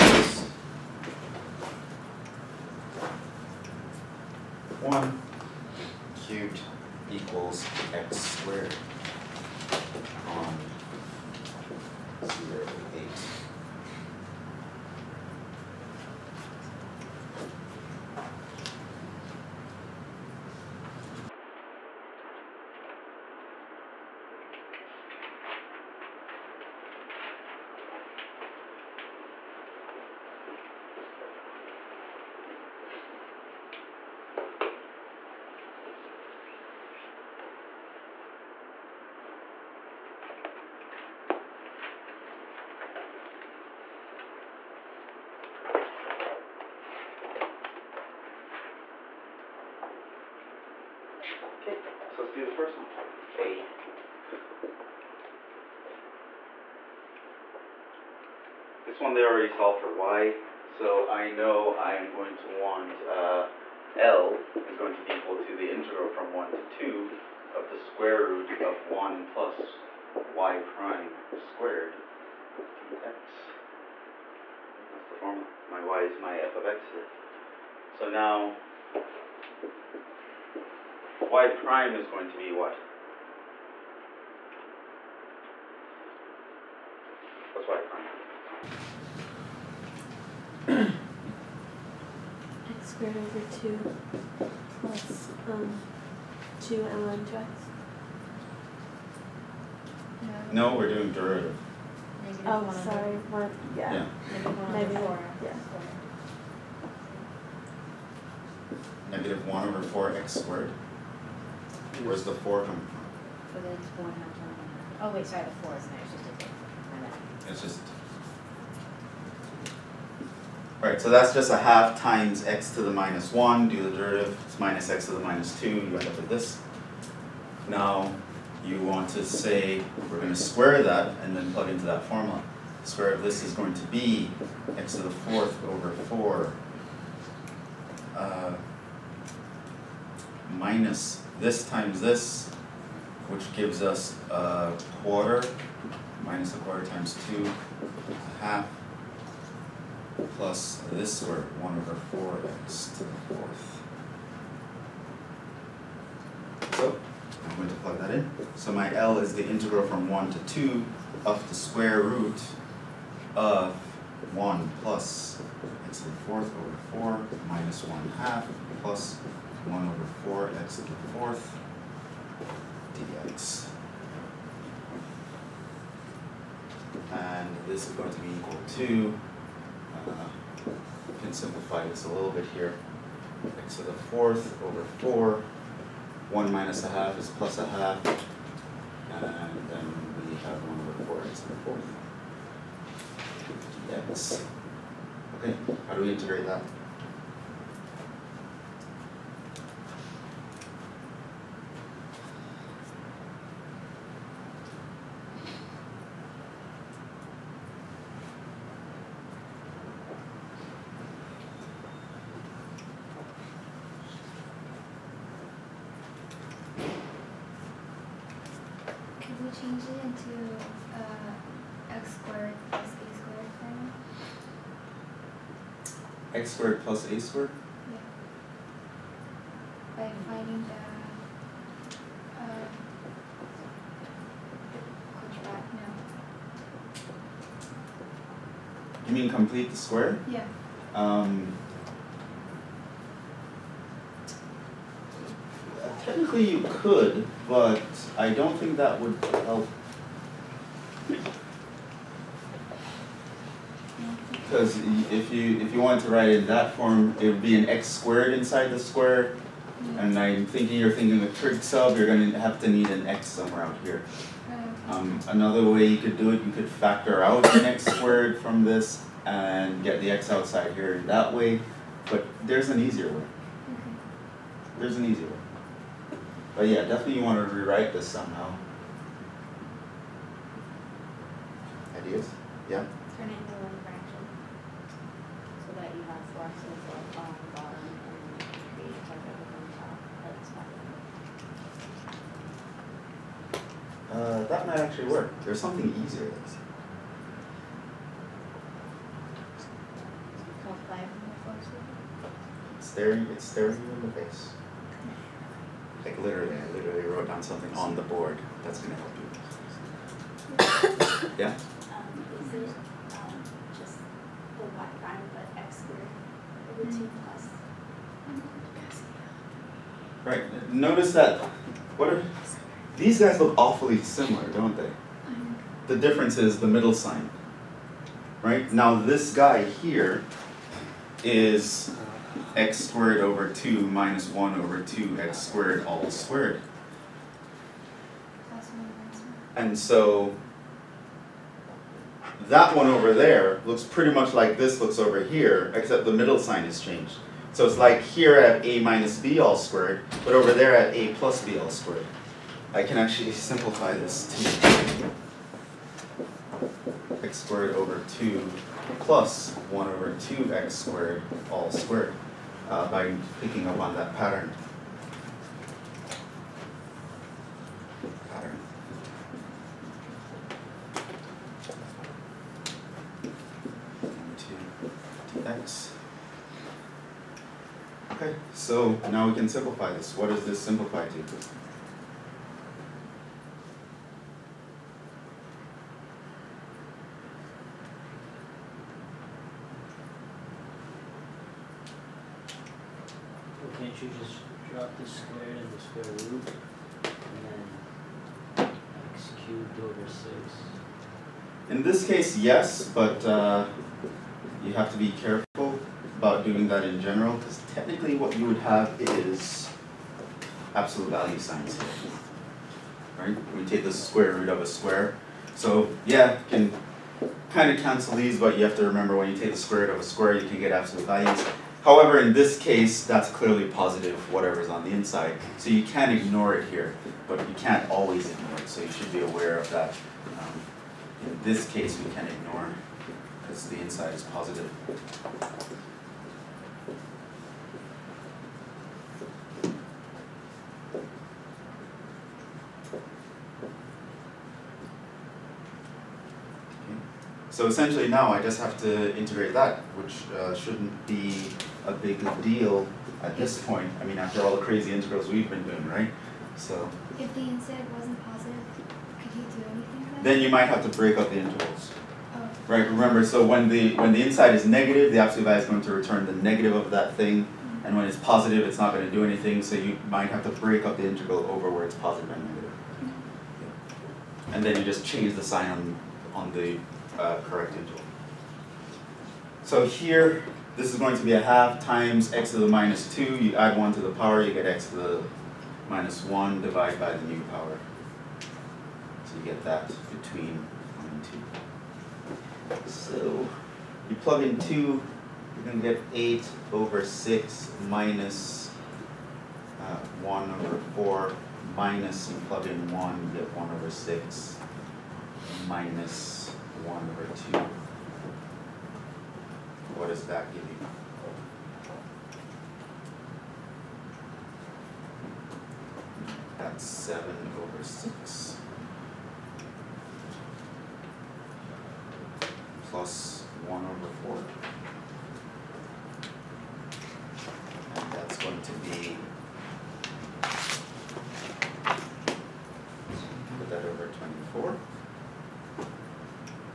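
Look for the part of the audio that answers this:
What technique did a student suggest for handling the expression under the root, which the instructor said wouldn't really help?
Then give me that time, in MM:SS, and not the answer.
03:59.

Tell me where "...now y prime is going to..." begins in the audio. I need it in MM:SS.
01:18.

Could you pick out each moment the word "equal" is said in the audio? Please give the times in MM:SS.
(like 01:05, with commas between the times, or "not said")
00:07, 01:05, 02:58.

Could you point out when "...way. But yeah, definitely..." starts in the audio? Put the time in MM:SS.
04:35.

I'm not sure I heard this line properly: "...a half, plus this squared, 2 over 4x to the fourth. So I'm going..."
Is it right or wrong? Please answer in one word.
wrong.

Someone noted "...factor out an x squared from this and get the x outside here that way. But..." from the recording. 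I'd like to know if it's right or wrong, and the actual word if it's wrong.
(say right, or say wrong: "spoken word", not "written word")
right.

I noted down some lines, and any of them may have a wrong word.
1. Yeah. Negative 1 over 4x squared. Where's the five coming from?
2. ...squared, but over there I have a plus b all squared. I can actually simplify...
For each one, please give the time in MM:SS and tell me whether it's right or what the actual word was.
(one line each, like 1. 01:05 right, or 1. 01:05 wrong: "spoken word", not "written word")
1. 01:49 wrong: "four", not "five"
2. 05:49 right.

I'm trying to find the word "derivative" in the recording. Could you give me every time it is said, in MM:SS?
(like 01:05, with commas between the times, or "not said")
01:41, 02:03.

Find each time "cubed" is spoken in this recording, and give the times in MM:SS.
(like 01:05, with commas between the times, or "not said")
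00:06, 06:39.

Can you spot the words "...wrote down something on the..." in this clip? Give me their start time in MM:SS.
05:07.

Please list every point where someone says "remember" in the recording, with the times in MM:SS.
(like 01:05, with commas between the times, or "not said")
06:58, 07:42.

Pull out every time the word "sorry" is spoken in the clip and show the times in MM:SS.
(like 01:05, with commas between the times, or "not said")
01:42, 01:55.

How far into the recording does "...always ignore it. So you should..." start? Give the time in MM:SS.
07:07.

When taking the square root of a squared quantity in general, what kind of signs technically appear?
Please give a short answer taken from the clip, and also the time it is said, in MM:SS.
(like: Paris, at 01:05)
absolute value signs, at 06:50.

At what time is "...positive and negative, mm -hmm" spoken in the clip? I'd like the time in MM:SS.
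07:52.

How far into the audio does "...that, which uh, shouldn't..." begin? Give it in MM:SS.
07:29.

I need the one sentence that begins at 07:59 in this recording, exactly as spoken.
So here, this is going to be a half times x to the minus 2.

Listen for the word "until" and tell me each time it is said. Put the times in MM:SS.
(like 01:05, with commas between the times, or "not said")
not said.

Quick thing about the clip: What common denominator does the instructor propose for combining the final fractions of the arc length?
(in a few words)
24.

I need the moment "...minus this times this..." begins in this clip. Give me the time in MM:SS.
02:20.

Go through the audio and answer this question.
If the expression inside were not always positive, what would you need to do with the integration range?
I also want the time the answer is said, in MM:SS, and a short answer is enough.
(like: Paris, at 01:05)
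break up the intervals, at 07:40.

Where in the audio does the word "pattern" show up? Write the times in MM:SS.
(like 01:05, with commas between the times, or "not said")
06:04, 06:08.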